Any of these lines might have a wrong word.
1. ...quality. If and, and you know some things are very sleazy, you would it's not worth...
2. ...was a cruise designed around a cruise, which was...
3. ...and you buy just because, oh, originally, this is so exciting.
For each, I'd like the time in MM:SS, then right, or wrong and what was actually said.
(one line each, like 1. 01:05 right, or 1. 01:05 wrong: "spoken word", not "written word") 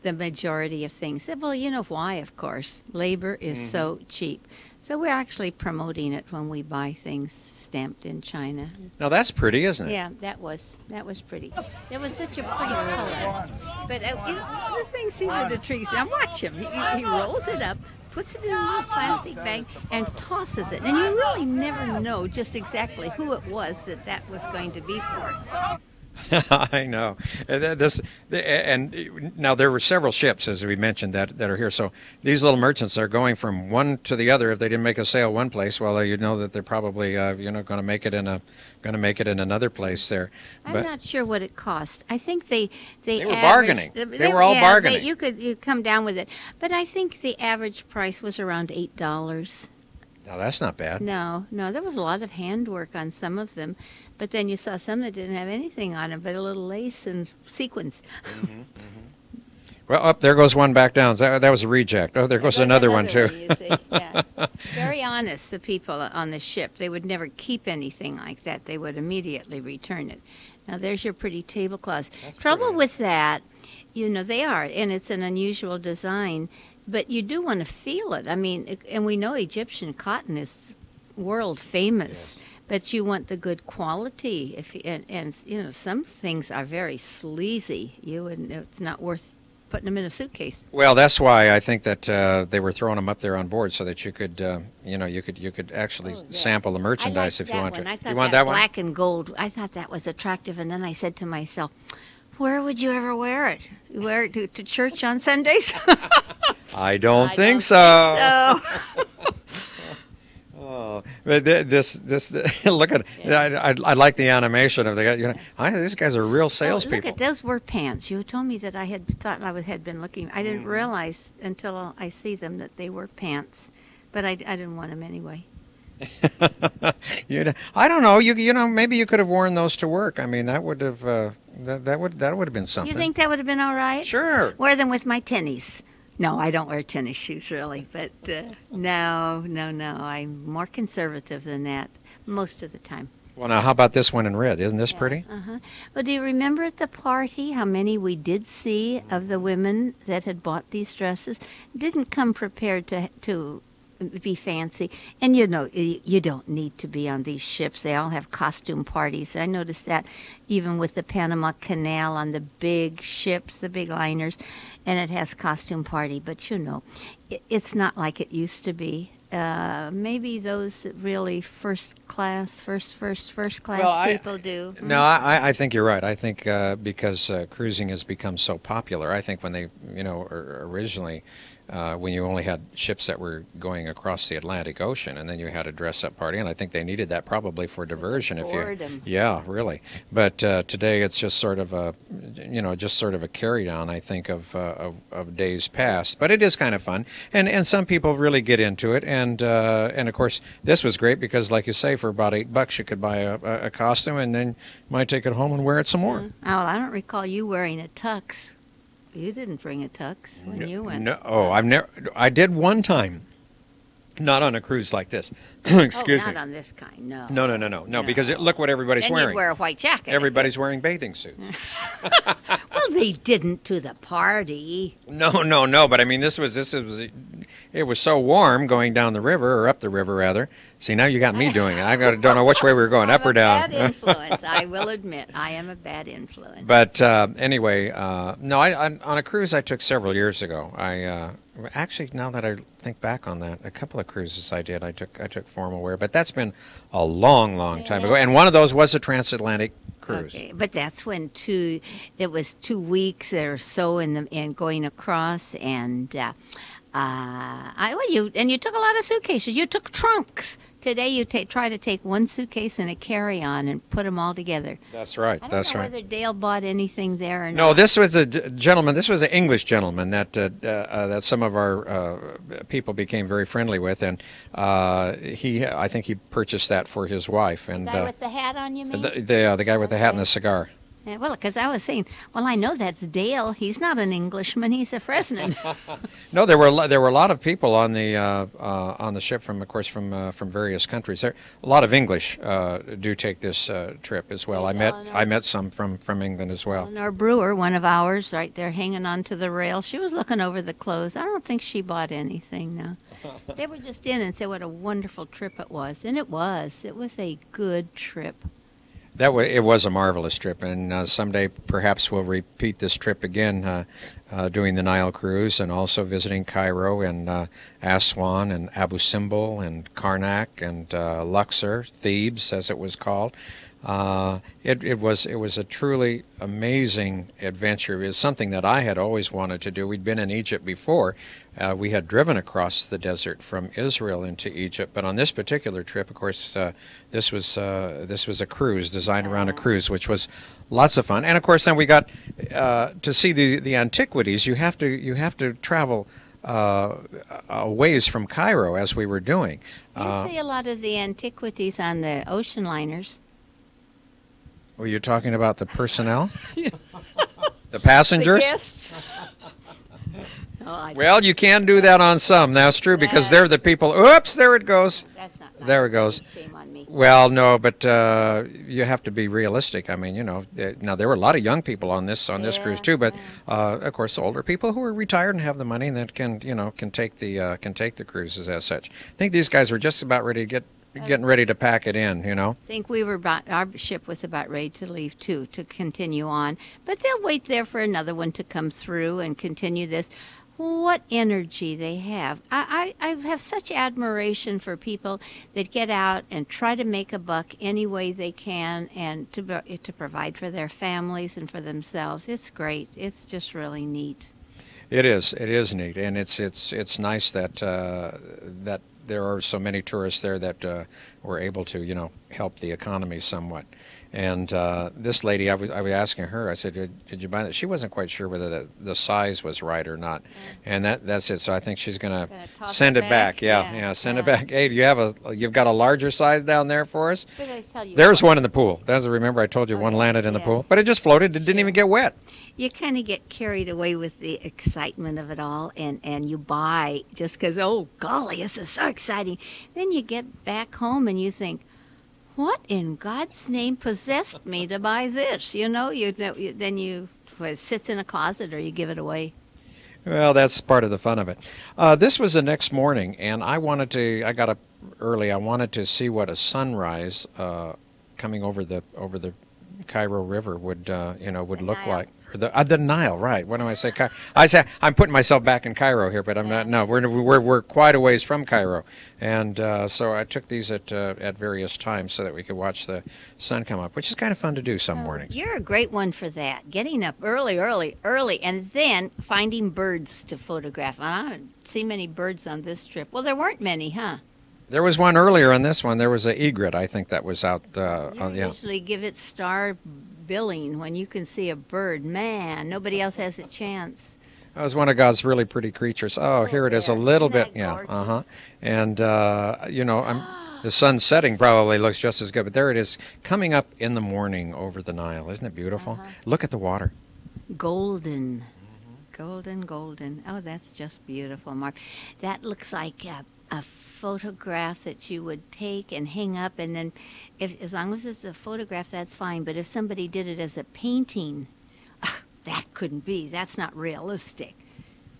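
1. 01:23 right
2. 05:38 right
3. 07:16 wrong: "golly", not "originally".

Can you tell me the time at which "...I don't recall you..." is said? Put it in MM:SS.
03:26.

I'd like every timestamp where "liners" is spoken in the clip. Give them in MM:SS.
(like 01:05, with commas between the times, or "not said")
02:43, 05:52.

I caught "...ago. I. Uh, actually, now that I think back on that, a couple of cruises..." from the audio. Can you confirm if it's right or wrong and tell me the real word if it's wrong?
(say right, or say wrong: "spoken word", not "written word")
right.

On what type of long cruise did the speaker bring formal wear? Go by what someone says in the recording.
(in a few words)
Transatlantic.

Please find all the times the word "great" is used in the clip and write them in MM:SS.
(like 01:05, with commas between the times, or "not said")
03:20, 06:42, 07:55.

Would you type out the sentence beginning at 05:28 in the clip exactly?
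It was something that I had always wanted to do.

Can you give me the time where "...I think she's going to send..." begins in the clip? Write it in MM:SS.
07:01.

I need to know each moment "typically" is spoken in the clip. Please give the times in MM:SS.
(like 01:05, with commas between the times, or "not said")
not said.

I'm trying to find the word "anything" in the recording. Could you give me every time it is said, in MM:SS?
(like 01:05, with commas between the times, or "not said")
00:55, 01:07, 04:26, 05:02.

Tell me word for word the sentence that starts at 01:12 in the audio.
with that, you know, they are, and it's an unusual design but you do want to feel it.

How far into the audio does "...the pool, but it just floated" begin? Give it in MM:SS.
07:10.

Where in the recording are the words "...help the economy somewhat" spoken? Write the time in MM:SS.
06:52.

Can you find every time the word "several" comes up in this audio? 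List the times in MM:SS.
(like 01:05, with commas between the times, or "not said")
00:29, 03:59.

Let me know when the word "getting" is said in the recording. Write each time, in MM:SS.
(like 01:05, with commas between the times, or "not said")
06:21, 07:56.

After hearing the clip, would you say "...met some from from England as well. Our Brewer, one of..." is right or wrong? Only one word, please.
right.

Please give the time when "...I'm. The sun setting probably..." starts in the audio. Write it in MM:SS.
08:20.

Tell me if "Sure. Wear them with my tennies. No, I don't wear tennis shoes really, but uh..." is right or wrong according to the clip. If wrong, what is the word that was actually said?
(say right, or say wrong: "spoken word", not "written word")
right.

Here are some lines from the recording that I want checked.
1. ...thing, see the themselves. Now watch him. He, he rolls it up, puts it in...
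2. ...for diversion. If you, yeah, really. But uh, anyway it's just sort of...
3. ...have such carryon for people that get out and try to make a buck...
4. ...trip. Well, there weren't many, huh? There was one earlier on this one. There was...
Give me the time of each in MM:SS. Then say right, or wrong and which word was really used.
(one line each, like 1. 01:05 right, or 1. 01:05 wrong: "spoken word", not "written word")
1. 00:14 wrong: "trees", not "themselves"
2. 03:07 wrong: "today", not "anyway"
3. 06:33 wrong: "admiration", not "carryon"
4. 08:02 right.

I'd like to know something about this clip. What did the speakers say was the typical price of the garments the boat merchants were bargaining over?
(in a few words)
$8.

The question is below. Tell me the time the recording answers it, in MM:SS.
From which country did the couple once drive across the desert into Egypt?
05:33.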